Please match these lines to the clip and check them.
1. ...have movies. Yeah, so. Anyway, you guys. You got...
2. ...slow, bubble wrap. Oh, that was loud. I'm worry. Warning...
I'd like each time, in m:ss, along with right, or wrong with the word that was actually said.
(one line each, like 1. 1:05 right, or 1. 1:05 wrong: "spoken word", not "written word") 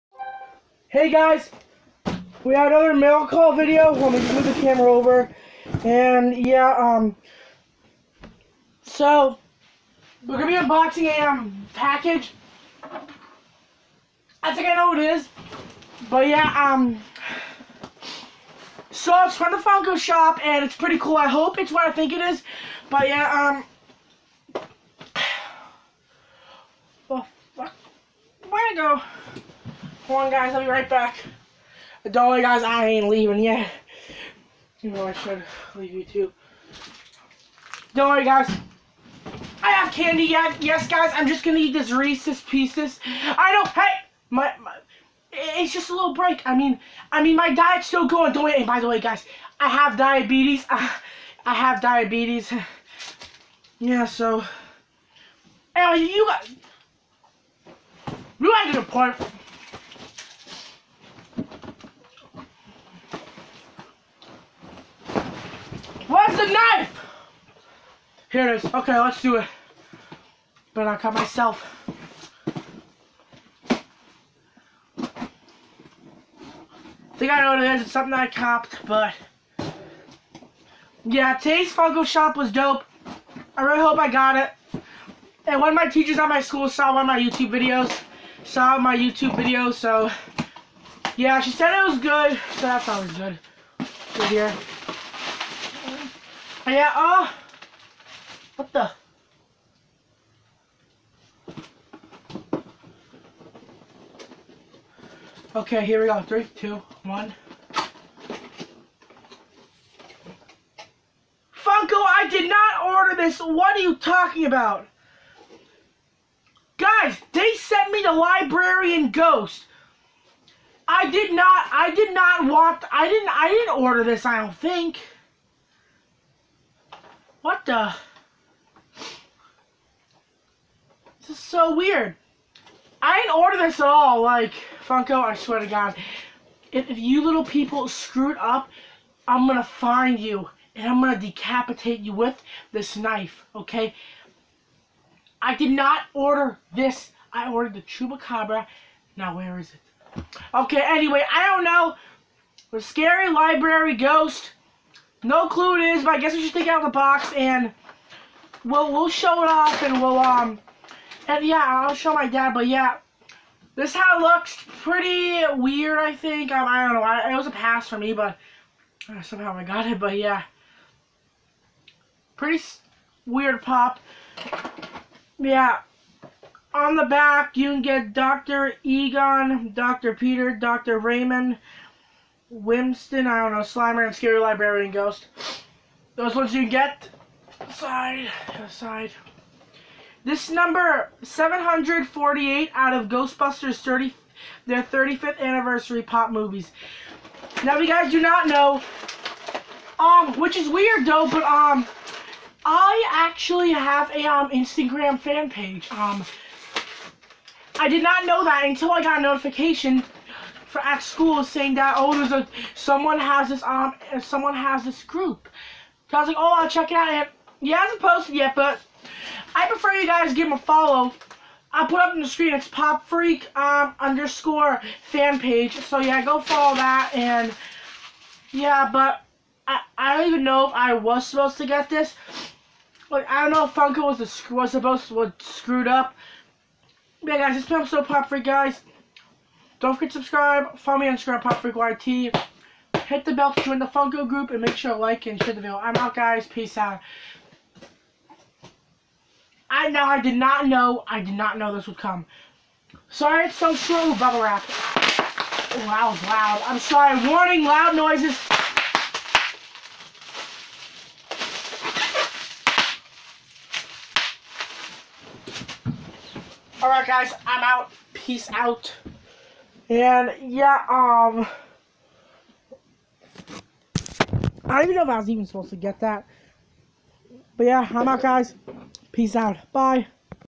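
1. 0:51 wrong: "diabetes", not "movies"
2. 4:13 wrong: "sorry", not "worry".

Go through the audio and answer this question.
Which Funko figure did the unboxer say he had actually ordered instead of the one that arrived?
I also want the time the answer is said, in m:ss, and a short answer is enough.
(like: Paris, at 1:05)
Chupacabra, at 2:27.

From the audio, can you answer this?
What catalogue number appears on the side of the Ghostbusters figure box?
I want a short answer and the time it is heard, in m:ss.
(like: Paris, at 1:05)
748, at 3:11.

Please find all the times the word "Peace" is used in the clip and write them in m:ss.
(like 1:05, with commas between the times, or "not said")
4:06, 4:28, 4:39.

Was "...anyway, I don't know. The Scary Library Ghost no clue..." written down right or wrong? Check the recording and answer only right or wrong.
right.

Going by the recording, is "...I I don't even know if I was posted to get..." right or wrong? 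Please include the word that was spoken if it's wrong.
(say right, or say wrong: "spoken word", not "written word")
wrong: "supposed", not "posted".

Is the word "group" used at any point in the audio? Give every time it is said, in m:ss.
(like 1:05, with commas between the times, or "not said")
3:35, 4:04.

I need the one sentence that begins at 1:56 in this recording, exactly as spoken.
Guys, they sent me the librarian ghost.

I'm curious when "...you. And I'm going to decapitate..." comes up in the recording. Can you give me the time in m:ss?
2:20.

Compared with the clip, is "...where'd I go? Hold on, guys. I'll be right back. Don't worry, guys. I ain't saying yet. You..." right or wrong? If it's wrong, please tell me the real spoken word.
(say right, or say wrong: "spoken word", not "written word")
wrong: "leaving", not "saying".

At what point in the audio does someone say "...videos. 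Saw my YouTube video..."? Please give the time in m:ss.
1:27.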